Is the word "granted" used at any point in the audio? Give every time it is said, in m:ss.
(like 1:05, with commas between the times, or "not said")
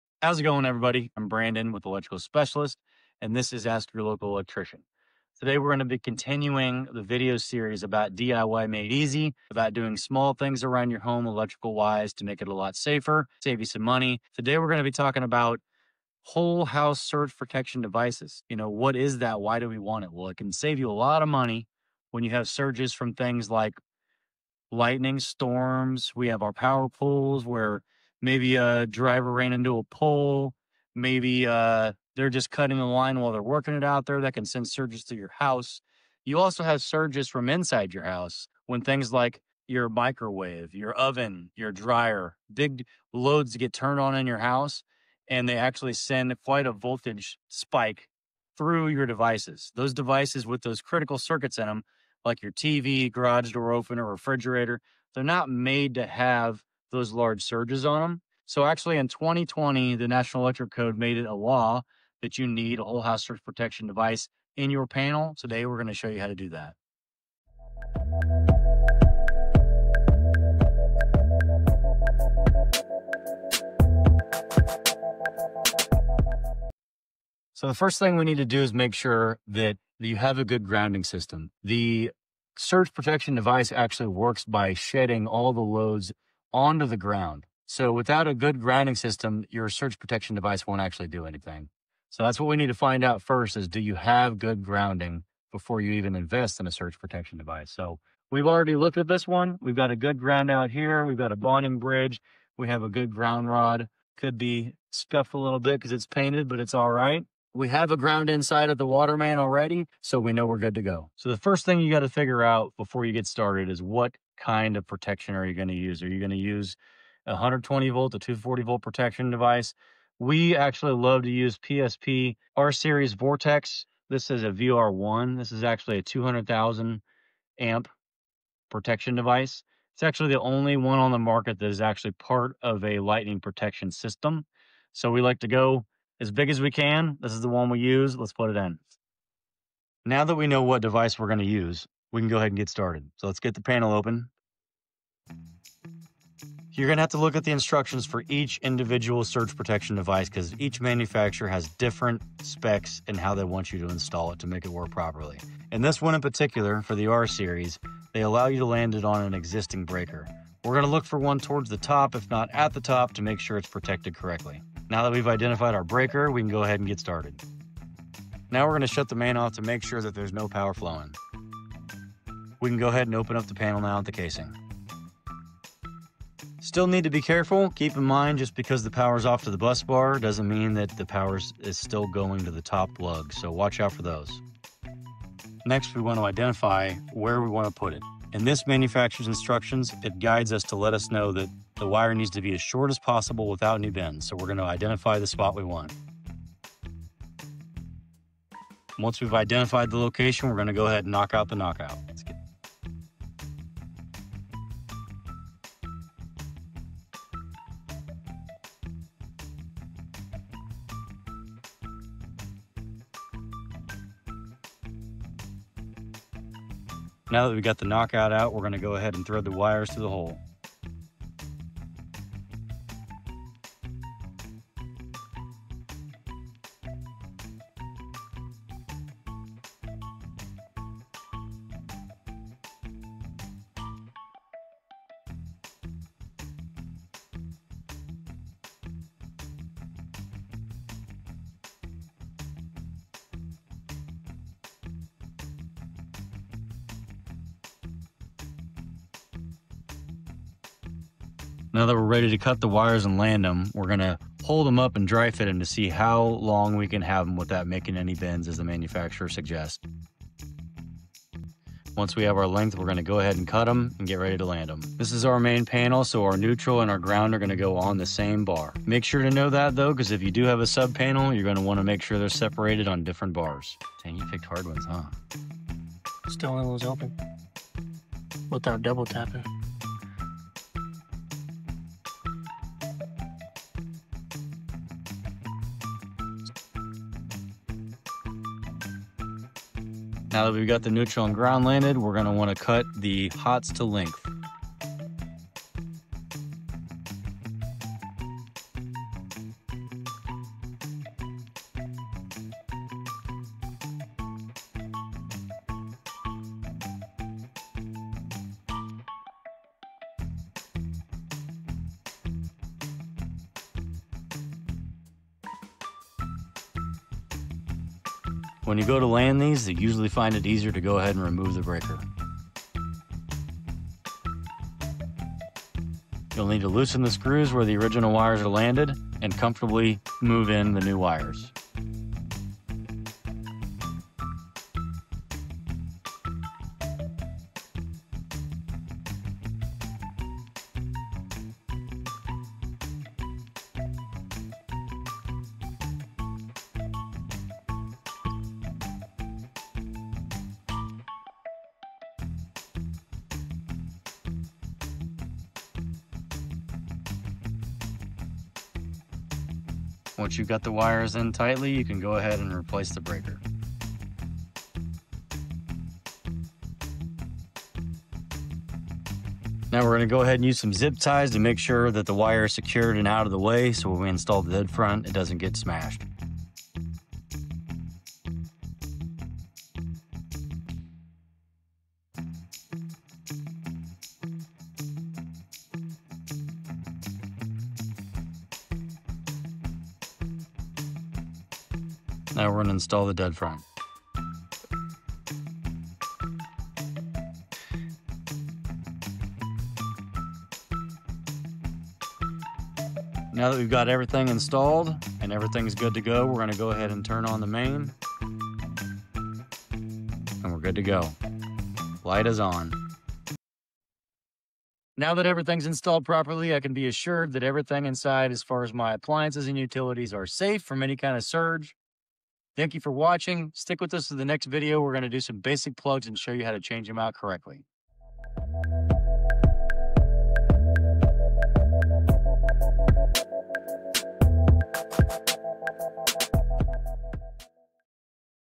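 not said.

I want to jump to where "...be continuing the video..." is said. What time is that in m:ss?
0:05.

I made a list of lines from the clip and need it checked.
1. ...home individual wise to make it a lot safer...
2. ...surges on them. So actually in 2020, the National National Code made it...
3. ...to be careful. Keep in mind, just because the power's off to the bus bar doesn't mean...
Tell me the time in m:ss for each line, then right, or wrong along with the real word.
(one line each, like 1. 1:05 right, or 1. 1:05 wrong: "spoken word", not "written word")
1. 0:10 wrong: "electrical", not "individual"
2. 0:57 wrong: "Electric", not "National"
3. 2:57 right.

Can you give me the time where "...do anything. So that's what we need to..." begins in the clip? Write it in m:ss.
1:31.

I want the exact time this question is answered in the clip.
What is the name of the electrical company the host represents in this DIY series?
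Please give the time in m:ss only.
0:01.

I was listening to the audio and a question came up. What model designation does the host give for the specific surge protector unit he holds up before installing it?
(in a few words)
VR1.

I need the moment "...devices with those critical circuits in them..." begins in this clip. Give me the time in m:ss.
0:49.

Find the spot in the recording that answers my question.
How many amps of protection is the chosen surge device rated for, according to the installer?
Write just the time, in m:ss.
2:06.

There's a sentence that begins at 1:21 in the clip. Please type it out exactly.
The surge protection device actually works by shedding all the loads onto the ground.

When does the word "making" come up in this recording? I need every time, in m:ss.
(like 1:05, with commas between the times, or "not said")
4:17.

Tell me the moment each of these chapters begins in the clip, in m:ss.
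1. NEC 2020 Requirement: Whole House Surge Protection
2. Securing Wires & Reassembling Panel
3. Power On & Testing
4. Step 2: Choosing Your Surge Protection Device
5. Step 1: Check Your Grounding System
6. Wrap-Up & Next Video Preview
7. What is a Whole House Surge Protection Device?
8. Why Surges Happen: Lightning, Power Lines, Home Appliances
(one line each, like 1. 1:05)
1. 1:40
2. 5:20
3. 6:10
4. 2:50
5. 2:10
6. 6:50
7. 0:25
8. 1:00.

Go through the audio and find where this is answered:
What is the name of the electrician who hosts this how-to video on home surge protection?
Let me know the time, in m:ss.
0:01.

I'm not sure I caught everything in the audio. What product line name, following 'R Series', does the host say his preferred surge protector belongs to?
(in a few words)
Vortex.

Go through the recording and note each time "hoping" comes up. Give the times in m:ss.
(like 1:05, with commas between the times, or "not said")
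not said.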